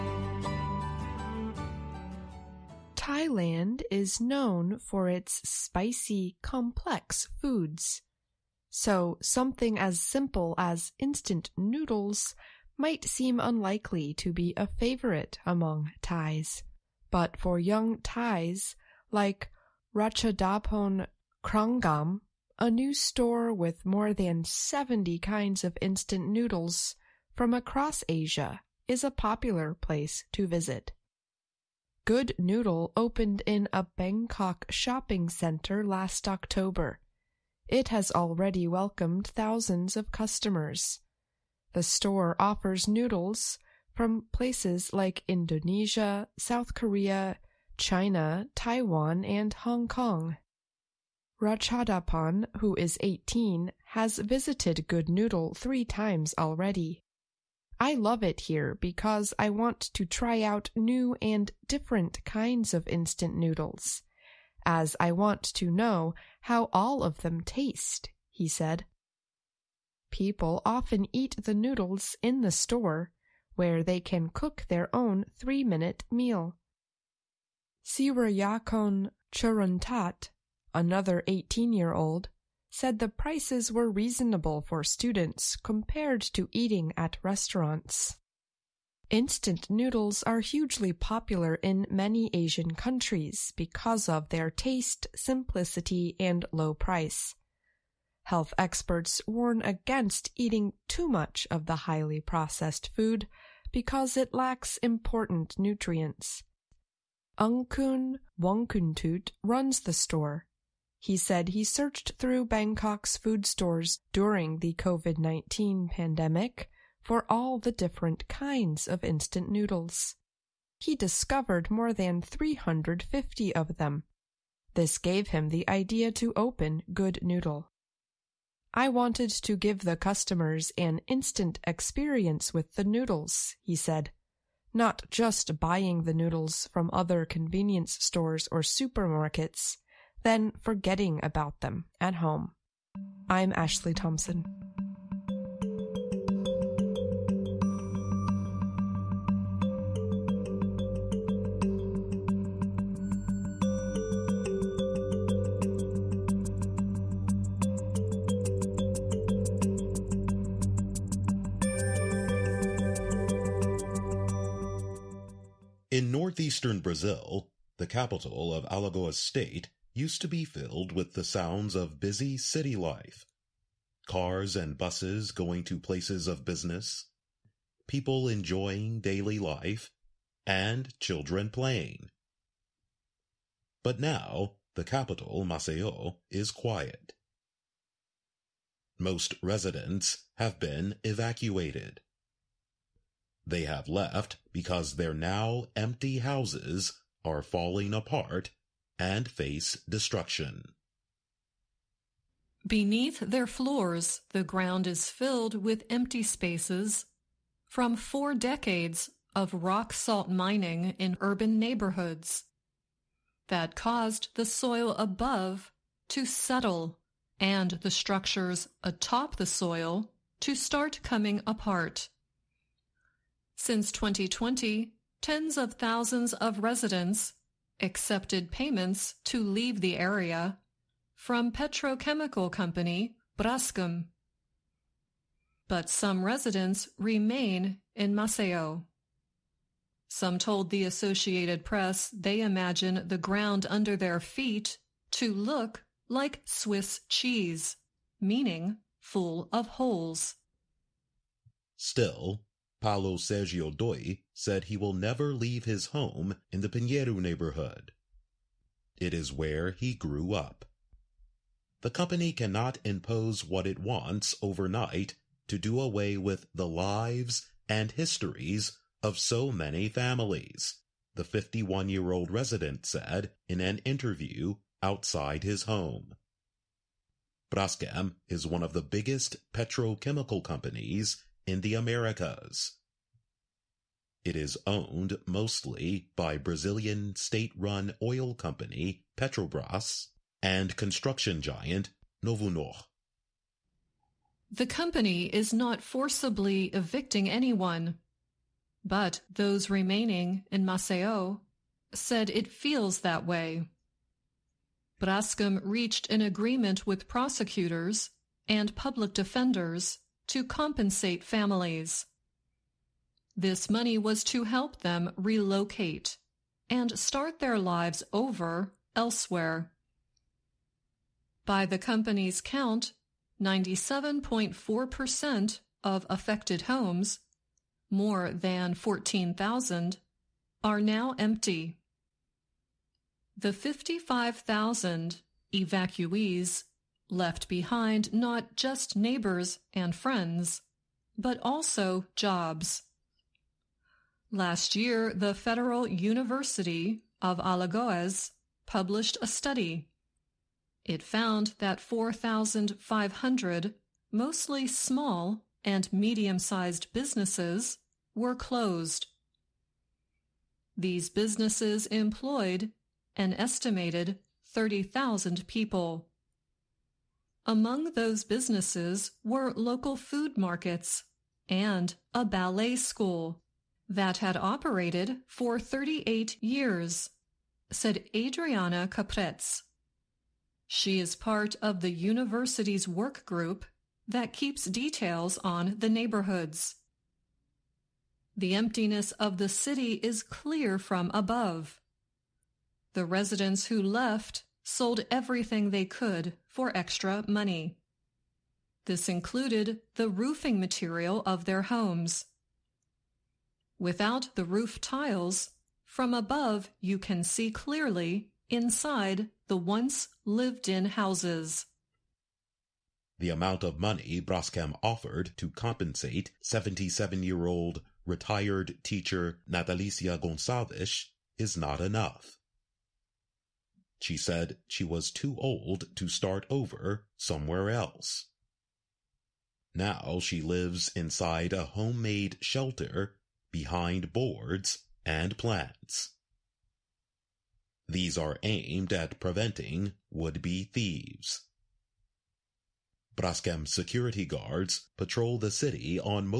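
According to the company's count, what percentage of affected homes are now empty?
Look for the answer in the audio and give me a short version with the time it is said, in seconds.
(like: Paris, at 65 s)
97.4%, at 323 s.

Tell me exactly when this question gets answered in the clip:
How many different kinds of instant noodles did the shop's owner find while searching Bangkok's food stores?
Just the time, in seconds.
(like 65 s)
121 s.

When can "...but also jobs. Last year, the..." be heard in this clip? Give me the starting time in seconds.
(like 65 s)
341 s.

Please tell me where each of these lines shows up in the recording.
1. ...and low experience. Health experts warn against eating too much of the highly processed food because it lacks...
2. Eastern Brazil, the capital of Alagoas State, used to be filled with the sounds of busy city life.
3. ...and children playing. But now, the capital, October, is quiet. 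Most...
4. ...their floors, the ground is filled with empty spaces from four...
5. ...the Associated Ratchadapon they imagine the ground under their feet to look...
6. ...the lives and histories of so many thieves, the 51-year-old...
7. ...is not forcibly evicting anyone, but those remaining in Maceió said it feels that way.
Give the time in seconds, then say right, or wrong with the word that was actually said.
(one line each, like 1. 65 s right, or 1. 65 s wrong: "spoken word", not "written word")
1. 96 s wrong: "price", not "experience"
2. 166 s right
3. 180 s wrong: "Maceió", not "October"
4. 203 s right
5. 240 s wrong: "Press", not "Ratchadapon"
6. 266 s wrong: "families", not "thieves"
7. 295 s right.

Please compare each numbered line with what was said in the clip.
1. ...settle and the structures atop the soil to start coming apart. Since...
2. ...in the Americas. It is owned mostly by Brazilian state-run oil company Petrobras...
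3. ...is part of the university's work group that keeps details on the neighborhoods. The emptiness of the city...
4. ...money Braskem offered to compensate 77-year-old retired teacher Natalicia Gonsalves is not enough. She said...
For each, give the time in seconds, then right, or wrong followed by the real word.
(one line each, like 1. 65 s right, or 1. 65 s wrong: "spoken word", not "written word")
1. 216 s right
2. 281 s right
3. 380 s right
4. 413 s right.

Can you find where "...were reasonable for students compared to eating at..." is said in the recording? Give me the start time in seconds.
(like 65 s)
83 s.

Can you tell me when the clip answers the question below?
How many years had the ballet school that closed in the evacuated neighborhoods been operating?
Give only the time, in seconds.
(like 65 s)
375 s.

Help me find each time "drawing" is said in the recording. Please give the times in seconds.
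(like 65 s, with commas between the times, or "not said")
not said.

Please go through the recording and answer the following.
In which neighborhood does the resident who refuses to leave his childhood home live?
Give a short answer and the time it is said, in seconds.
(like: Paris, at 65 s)
Pinheiro, at 256 s.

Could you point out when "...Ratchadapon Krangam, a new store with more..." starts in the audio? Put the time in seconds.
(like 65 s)
19 s.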